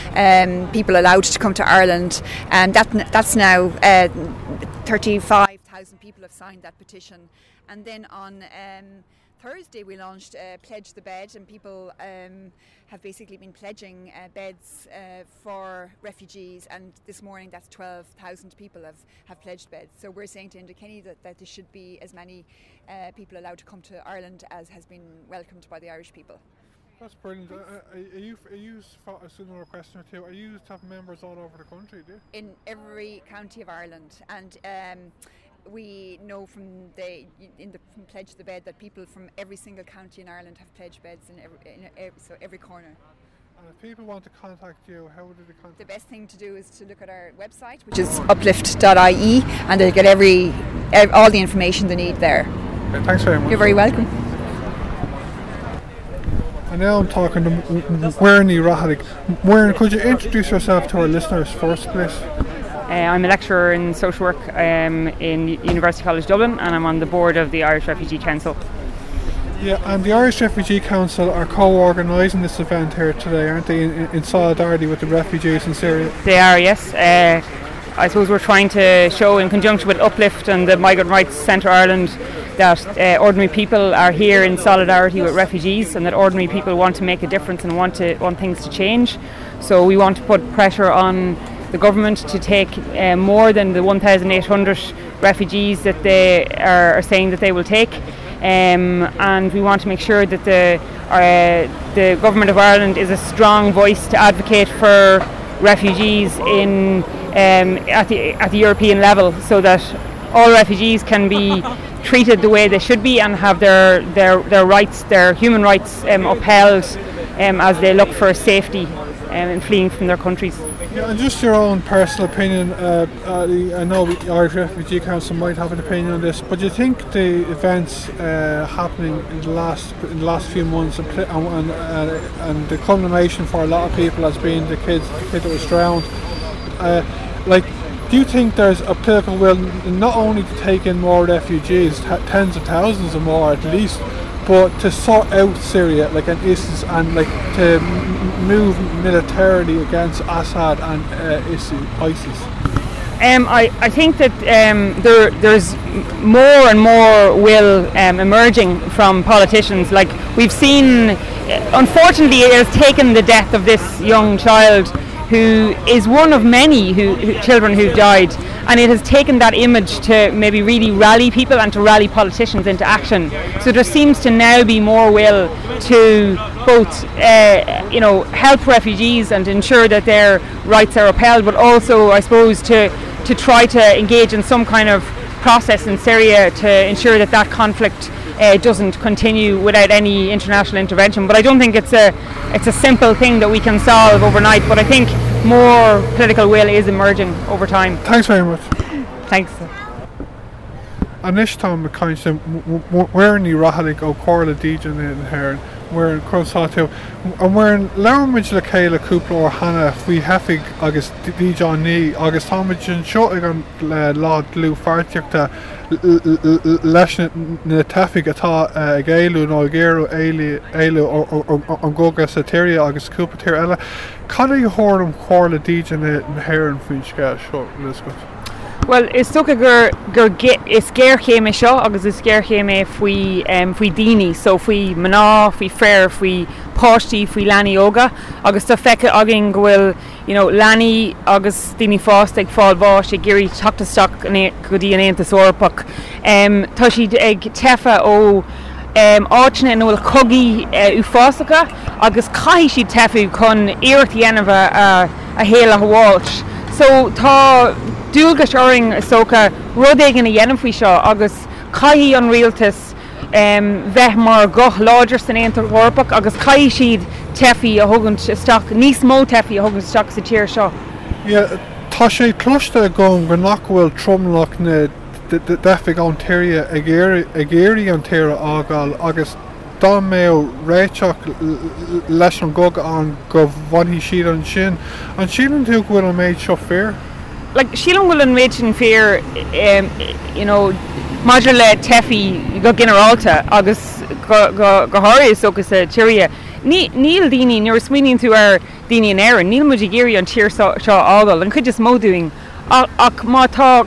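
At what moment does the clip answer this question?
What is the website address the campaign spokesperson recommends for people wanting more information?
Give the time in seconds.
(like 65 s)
48 s.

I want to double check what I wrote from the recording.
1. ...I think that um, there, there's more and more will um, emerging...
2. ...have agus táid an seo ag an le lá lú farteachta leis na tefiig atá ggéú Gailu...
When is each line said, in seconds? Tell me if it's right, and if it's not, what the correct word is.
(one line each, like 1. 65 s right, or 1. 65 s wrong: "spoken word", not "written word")
1. 153 s right
2. 210 s right.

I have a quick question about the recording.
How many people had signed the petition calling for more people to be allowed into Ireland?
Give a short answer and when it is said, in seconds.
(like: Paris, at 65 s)
35,000, at 4 s.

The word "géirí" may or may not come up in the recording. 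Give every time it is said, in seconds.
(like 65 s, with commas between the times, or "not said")
243 s, 277 s.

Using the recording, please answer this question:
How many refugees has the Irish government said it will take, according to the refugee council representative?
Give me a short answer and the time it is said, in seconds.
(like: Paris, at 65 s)
1,800, at 93 s.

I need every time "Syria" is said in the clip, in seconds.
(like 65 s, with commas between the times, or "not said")
75 s, 145 s, 185 s.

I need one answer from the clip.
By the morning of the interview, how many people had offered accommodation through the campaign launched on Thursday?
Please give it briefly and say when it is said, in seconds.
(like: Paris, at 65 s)
12,000, at 17 s.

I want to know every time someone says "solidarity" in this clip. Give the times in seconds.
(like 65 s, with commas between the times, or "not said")
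74 s, 84 s.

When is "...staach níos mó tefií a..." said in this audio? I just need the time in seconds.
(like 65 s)
268 s.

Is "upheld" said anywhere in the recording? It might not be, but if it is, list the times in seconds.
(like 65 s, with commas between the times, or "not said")
116 s, 181 s.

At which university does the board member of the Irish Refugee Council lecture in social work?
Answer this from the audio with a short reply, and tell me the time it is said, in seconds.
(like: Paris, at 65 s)
University College Dublin, at 65 s.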